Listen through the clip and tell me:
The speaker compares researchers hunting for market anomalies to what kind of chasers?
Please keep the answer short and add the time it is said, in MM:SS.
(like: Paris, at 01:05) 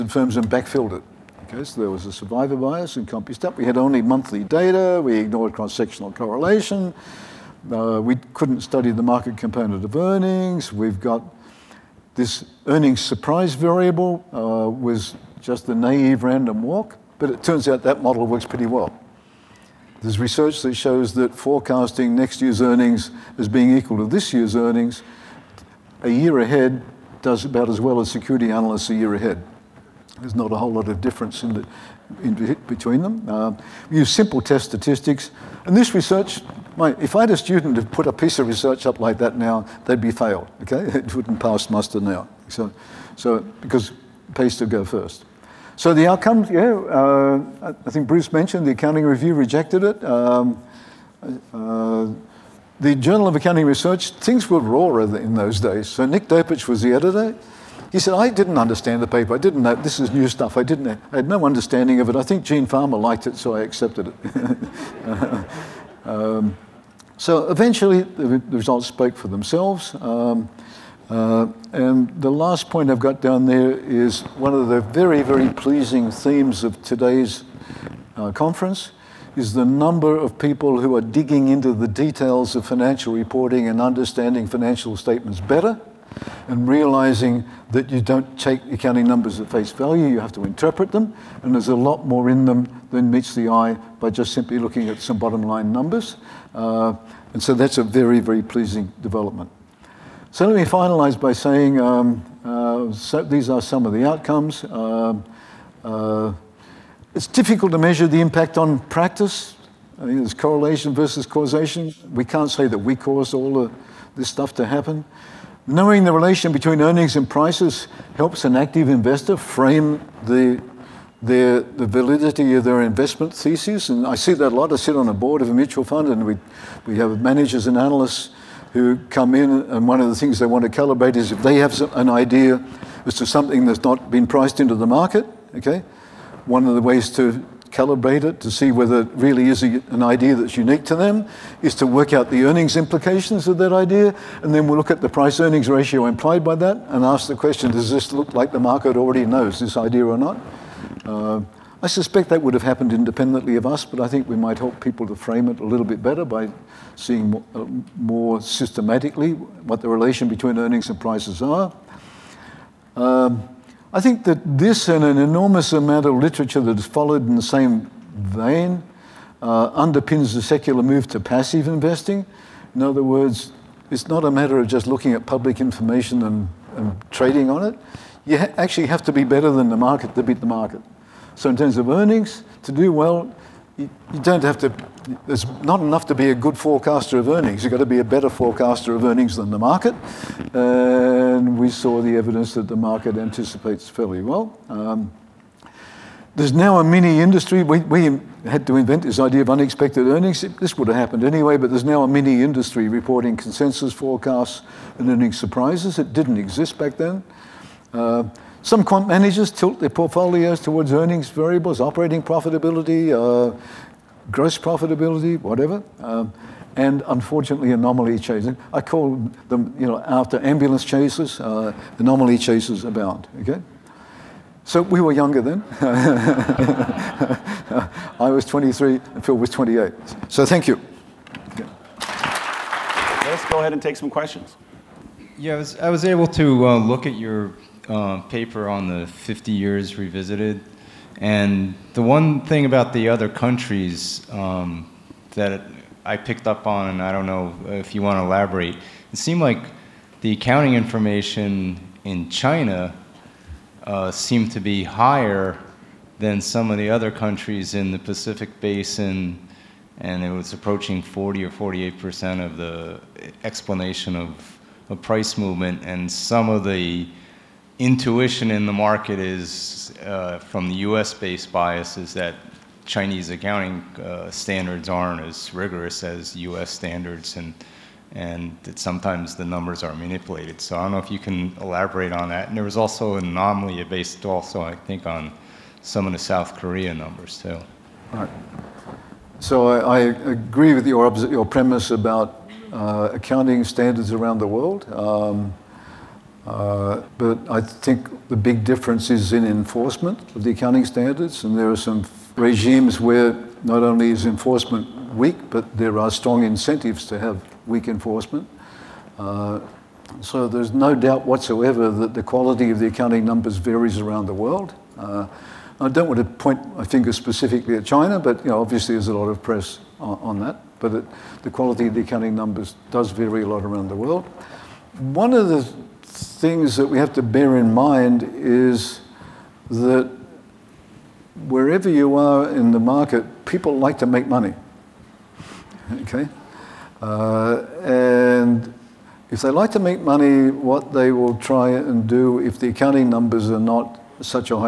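ambulance chasers, at 03:40.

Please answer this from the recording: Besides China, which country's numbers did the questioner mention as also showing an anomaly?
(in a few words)
South Korea.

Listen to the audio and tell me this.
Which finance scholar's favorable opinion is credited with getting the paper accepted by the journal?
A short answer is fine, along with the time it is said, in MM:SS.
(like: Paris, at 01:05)
Gene Fama, at 01:02.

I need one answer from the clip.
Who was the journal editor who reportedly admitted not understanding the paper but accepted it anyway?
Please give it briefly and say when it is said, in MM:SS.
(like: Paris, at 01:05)
Nick Dopuch, at 00:56.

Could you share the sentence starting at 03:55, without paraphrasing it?
Yeah, I was, I was able to uh, look at your uh, paper on the 50 years revisited.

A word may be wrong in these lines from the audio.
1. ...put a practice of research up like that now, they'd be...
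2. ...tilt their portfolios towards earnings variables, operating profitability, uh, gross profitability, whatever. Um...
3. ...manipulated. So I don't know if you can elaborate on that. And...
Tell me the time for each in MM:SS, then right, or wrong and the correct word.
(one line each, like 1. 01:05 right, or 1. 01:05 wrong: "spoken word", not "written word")
1. 00:37 wrong: "piece", not "practice"
2. 03:29 right
3. 04:39 right.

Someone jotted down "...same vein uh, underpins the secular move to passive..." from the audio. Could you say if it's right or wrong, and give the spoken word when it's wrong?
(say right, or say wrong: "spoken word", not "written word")
right.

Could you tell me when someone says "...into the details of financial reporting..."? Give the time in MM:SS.
01:21.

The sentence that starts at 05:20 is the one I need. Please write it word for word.
But it, the quality of the accounting numbers does vary a lot around the world.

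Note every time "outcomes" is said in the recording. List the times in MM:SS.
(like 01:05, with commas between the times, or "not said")
00:46, 01:44.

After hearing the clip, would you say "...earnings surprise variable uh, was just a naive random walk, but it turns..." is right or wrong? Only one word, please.
right.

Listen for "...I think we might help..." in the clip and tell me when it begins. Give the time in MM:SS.
02:33.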